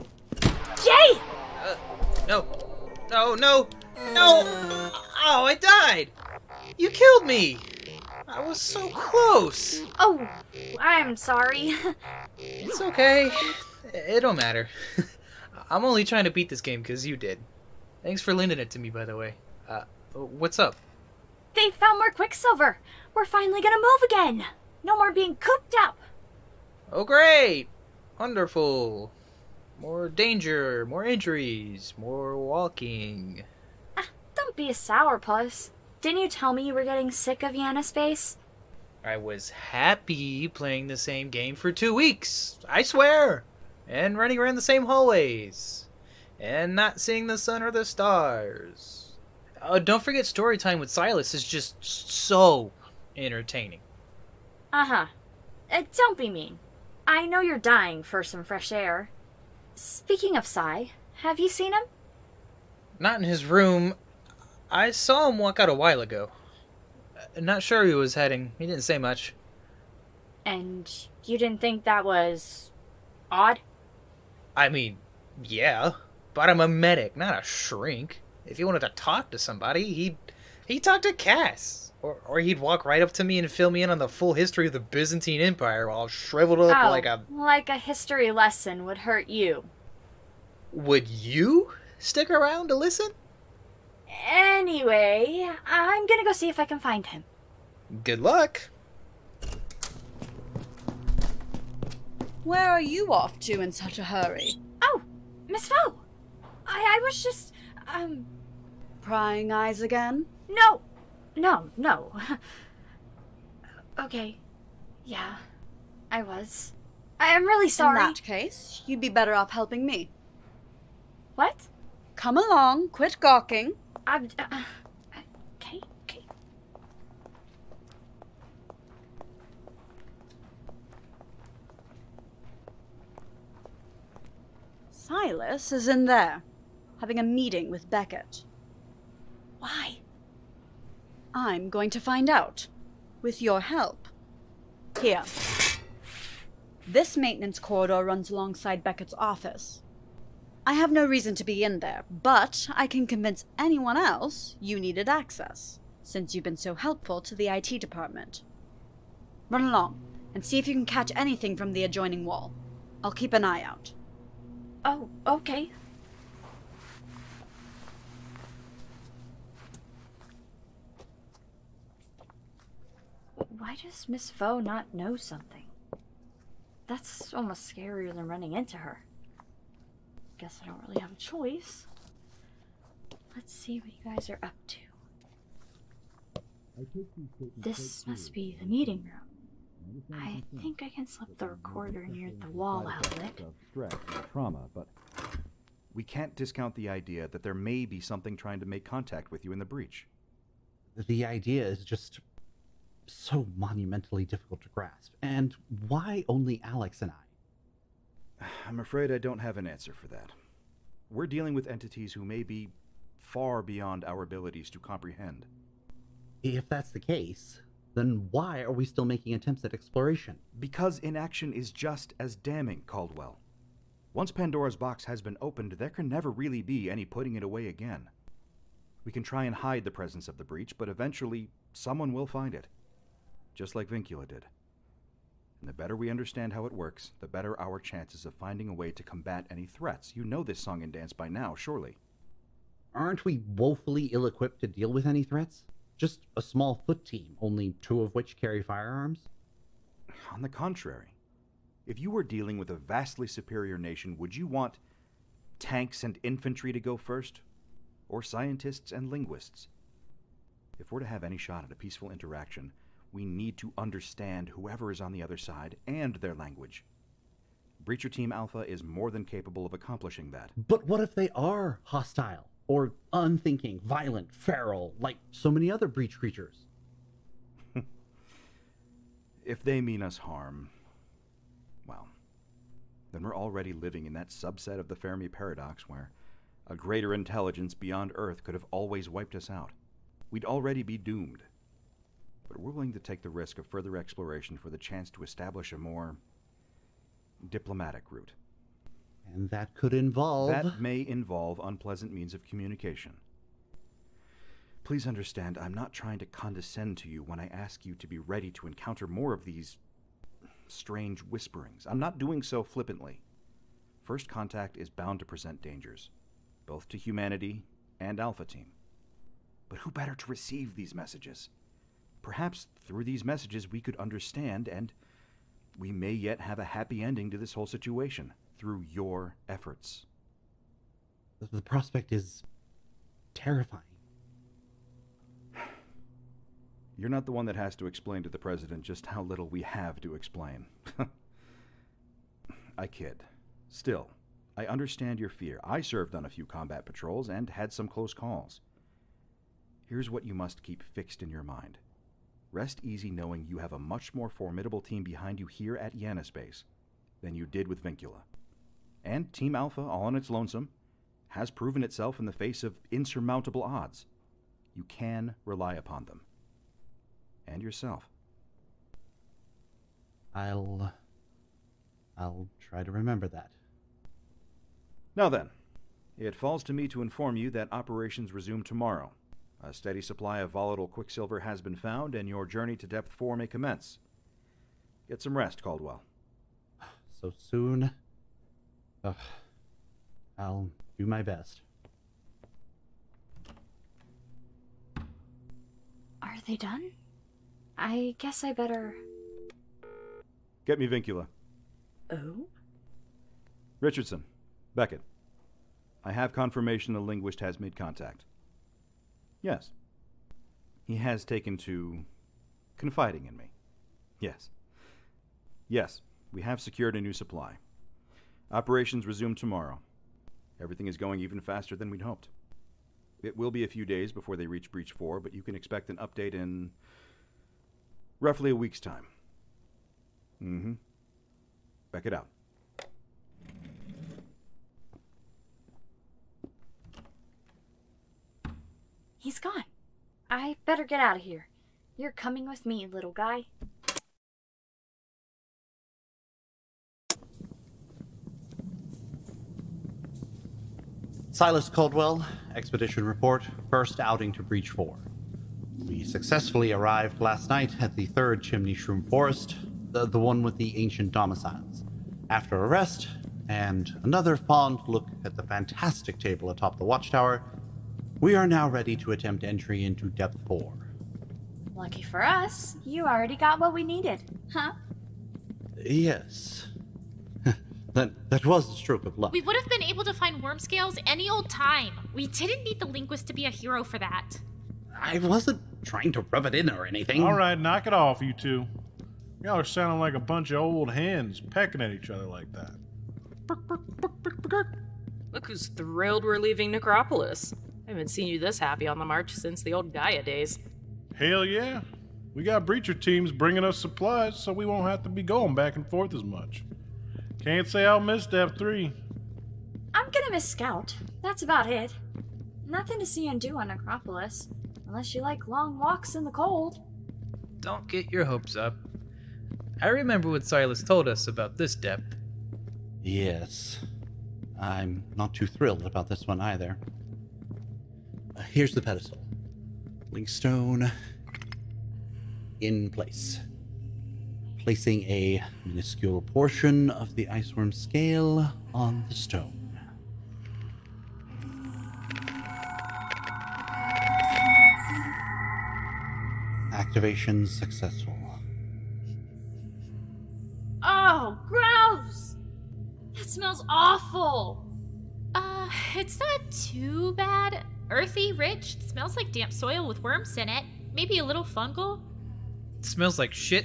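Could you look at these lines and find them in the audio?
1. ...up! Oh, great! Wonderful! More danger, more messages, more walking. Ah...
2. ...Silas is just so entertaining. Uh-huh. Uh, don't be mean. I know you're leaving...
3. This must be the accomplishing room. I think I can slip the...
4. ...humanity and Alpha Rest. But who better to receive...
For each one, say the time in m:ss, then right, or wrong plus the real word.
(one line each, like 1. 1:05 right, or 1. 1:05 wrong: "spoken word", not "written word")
1. 0:25 wrong: "injuries", not "messages"
2. 0:50 wrong: "dying", not "leaving"
3. 3:07 wrong: "meeting", not "accomplishing"
4. 5:16 wrong: "Team", not "Rest".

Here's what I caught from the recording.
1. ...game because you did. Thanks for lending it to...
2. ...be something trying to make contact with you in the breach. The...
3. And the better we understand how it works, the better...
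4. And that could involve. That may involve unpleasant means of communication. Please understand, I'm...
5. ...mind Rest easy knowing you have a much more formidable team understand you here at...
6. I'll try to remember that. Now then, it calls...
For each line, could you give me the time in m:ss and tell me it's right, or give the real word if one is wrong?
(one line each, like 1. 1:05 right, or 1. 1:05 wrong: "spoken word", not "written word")
1. 0:16 right
2. 3:17 right
3. 3:55 right
4. 4:59 right
5. 5:51 wrong: "behind", not "understand"
6. 6:12 wrong: "falls", not "calls".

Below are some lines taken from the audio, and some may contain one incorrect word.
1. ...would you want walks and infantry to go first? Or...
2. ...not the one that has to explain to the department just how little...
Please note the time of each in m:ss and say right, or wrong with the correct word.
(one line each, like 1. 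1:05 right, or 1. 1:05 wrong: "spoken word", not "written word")
1. 4:14 wrong: "tanks", not "walks"
2. 5:37 wrong: "president", not "department".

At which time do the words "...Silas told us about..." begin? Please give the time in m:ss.
8:40.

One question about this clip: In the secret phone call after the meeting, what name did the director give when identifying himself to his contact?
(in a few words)
Richardson.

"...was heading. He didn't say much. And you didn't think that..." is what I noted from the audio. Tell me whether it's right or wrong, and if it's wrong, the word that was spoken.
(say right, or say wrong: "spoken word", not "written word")
right.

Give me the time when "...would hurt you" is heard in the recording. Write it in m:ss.
1:28.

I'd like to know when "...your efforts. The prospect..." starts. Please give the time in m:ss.
5:28.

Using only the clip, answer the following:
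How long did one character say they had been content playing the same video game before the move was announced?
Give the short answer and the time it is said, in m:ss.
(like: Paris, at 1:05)
2 weeks, at 0:41.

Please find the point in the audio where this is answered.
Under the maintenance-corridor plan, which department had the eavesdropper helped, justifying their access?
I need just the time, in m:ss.
2:37.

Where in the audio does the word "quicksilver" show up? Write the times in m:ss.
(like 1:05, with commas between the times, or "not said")
0:22, 6:20.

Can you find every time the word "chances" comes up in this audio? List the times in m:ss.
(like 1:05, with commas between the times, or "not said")
3:57, 4:54.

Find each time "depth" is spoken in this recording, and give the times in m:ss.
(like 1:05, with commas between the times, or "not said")
6:22, 7:50, 8:41.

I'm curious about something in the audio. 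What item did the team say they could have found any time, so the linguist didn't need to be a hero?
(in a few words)
Worm scales.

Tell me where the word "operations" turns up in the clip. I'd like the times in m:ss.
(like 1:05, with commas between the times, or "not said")
6:17, 6:58.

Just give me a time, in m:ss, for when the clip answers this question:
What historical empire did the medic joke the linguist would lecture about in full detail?
1:24.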